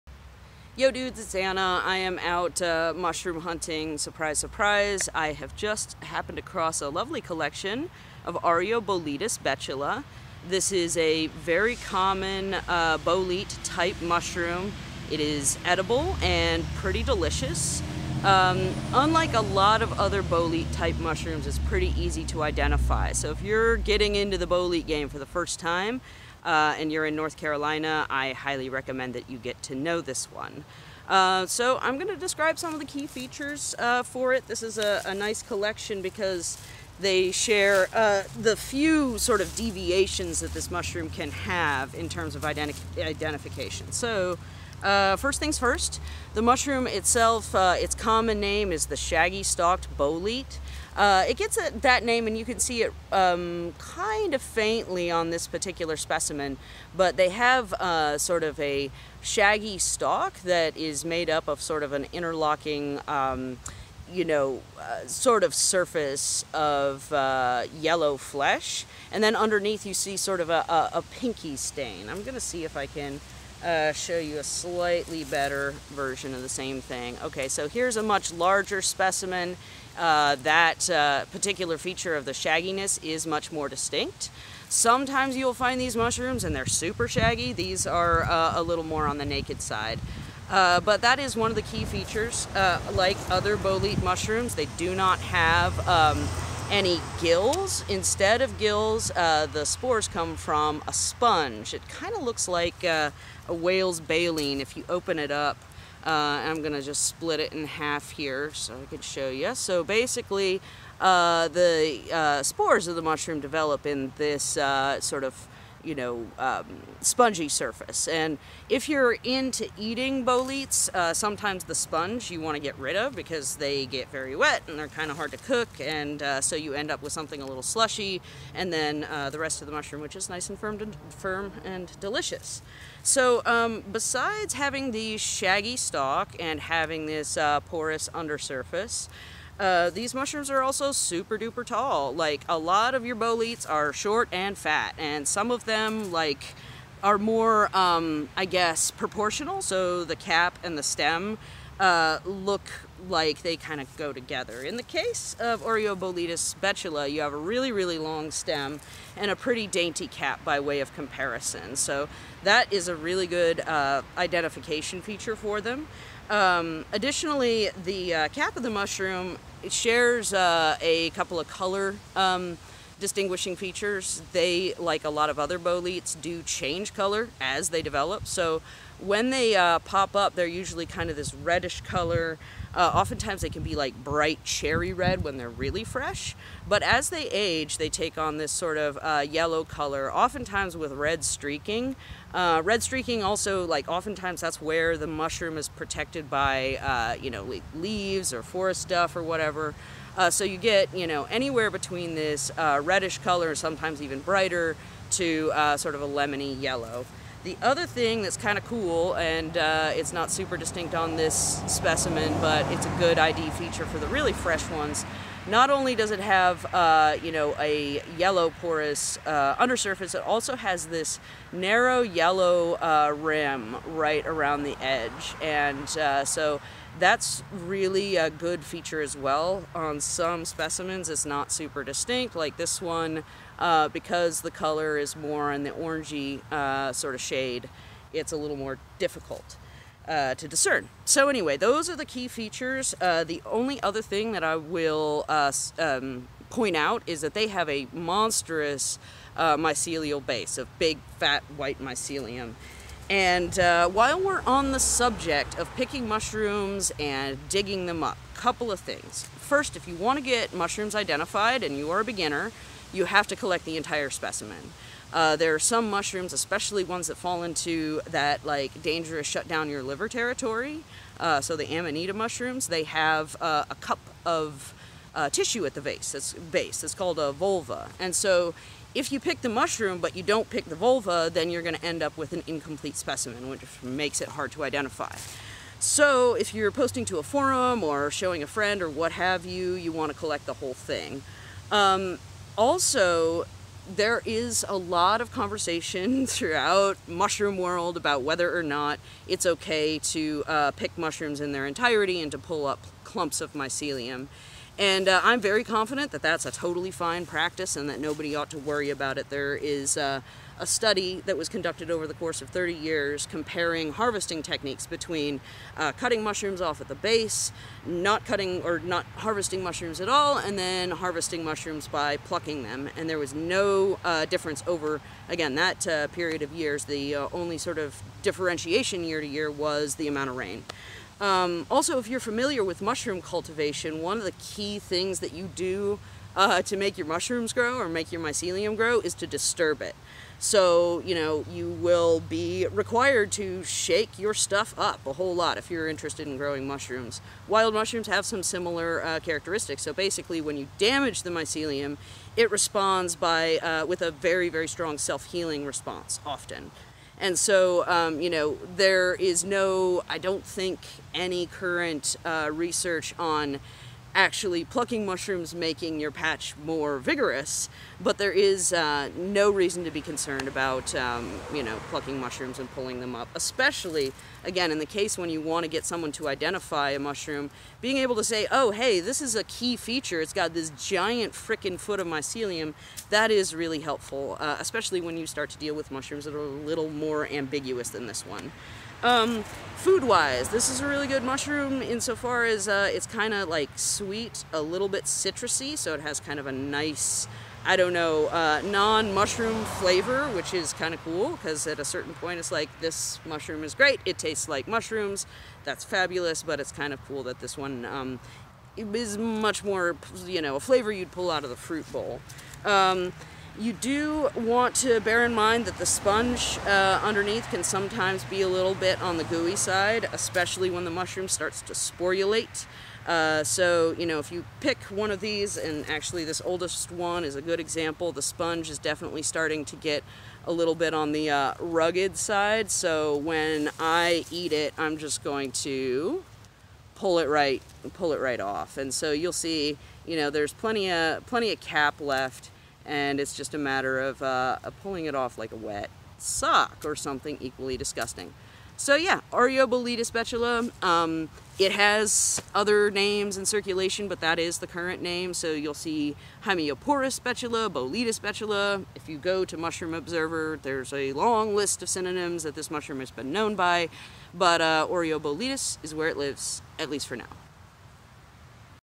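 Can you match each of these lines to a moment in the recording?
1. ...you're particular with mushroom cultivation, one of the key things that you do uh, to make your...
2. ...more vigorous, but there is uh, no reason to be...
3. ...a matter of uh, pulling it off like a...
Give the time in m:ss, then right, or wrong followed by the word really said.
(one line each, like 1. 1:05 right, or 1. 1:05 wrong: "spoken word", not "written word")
1. 5:32 wrong: "familiar", not "particular"
2. 6:06 right
3. 7:23 right.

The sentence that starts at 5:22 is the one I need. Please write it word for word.
And there was no uh, difference over, again, that uh, period of years.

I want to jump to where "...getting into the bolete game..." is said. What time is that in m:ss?
0:23.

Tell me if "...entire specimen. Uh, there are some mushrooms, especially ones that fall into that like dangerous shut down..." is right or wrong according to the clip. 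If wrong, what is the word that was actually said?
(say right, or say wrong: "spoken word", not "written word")
right.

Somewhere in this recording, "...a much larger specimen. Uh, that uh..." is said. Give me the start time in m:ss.
1:17.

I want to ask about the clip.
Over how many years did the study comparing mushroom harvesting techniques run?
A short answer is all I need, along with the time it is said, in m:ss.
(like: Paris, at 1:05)
30, at 5:12.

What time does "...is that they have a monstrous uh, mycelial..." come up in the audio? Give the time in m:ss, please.
4:07.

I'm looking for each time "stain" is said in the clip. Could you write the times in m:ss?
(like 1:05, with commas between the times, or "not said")
1:11.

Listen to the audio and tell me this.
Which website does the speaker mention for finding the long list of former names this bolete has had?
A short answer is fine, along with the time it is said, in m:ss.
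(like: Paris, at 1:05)
Mushroom Observer, at 7:39.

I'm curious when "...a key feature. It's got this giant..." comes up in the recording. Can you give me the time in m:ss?
6:19.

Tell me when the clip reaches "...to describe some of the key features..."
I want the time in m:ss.
0:32.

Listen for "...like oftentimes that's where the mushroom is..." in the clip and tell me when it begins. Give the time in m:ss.
3:13.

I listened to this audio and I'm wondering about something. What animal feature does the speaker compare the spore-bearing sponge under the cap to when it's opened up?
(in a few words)
whale's baleen.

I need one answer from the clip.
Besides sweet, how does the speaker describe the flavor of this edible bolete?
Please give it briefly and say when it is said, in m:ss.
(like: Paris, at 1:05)
citrusy, at 6:35.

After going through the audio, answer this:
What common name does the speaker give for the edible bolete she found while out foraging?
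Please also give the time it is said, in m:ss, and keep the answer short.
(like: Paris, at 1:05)
shaggy-stalked bolete, at 0:48.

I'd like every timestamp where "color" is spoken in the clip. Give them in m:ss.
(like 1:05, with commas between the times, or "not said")
2:51, 2:56, 3:01, 3:09, 3:23, 3:54.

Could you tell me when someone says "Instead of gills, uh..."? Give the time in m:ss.
1:37.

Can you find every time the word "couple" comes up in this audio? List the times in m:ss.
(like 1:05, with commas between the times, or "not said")
2:51, 4:18.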